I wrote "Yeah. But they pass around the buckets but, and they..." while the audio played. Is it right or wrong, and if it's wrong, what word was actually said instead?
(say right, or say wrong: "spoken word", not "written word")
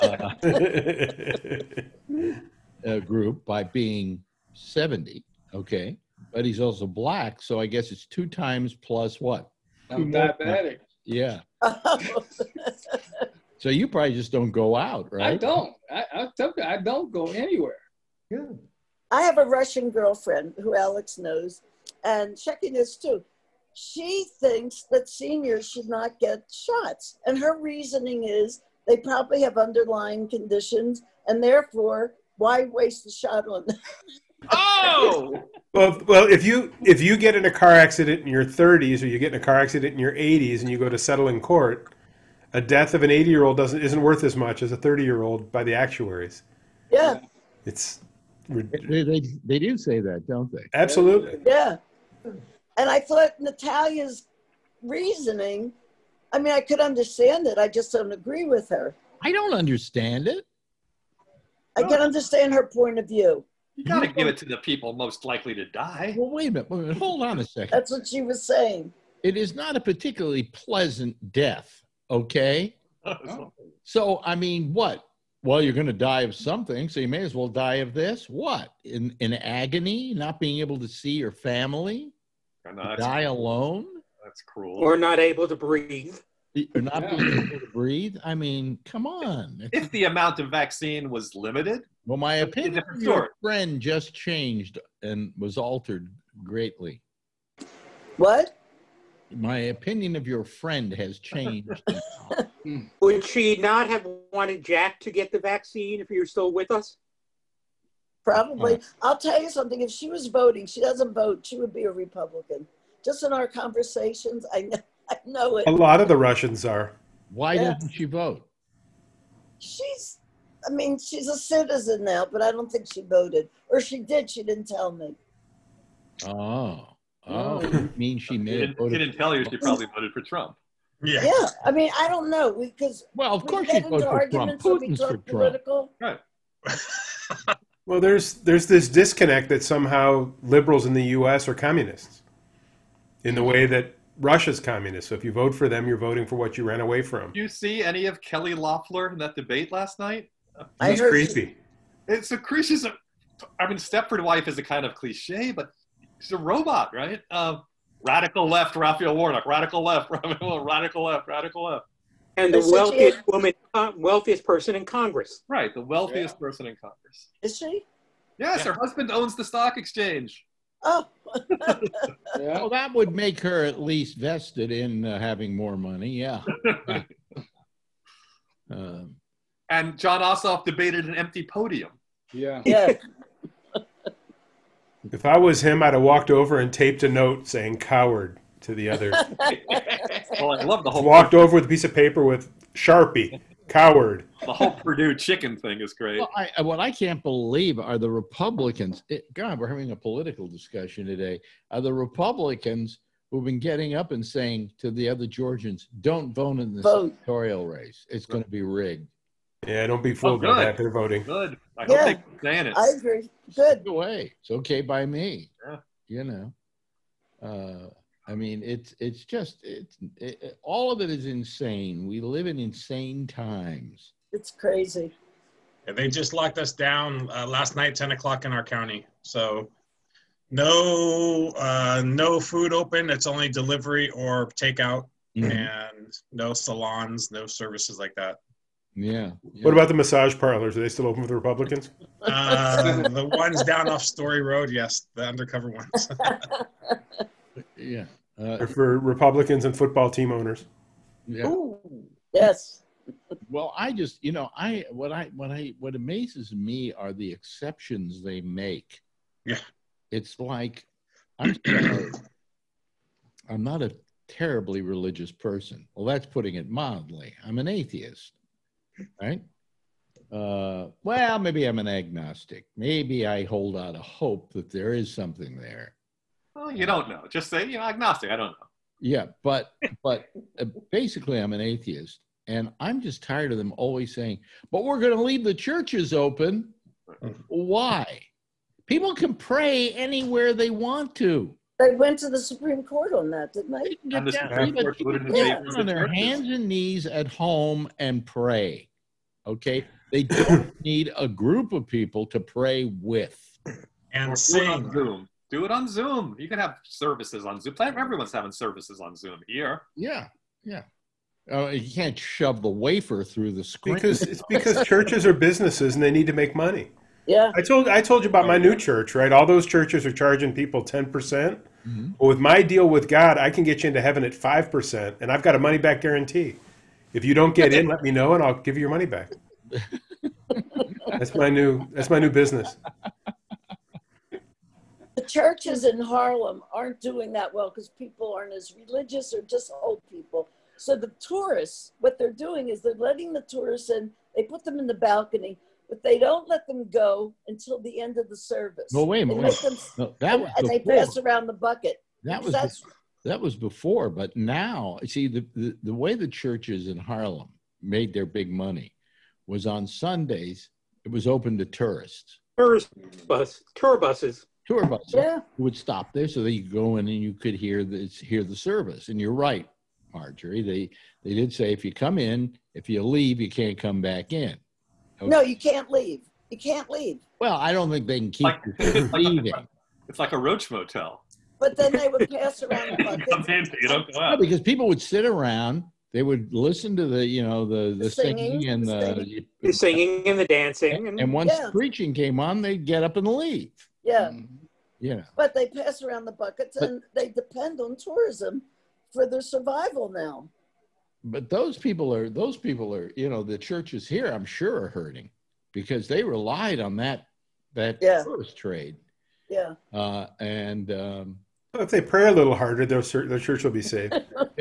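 right.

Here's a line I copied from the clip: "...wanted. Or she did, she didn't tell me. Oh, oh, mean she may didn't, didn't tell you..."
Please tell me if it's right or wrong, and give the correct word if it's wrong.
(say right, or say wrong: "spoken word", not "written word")
wrong: "voted", not "wanted".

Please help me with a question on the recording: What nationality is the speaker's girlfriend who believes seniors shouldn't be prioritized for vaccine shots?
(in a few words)
Russian.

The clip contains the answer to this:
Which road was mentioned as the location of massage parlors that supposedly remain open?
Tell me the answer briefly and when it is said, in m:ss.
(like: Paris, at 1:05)
Story Road, at 4:04.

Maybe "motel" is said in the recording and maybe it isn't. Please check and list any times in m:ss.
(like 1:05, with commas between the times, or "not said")
6:20.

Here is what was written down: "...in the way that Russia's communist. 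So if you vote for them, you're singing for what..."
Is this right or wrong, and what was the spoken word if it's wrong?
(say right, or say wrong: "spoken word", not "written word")
wrong: "voting", not "singing".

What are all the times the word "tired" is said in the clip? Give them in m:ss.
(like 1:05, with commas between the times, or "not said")
4:43.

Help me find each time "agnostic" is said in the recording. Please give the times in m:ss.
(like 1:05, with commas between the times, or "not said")
4:31, 4:37.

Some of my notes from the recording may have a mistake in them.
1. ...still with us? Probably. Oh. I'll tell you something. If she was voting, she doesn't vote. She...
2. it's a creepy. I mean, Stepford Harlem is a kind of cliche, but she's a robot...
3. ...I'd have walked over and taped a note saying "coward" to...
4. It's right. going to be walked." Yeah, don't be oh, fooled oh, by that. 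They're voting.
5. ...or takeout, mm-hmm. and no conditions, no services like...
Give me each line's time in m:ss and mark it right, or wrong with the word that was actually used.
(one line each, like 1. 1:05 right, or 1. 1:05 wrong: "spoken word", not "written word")
1. 1:46 right
2. 2:32 wrong: "Wife", not "Harlem"
3. 3:05 right
4. 3:28 wrong: "rigged", not "walked"
5. 3:54 wrong: "salons", not "conditions".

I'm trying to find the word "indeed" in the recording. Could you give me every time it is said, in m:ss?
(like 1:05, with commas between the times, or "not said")
not said.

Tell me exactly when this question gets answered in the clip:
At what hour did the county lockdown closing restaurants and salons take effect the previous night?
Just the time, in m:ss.
3:47.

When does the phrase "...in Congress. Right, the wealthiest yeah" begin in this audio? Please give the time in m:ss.
2:44.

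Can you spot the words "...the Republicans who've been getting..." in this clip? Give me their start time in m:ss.
3:21.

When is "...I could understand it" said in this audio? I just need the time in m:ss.
0:56.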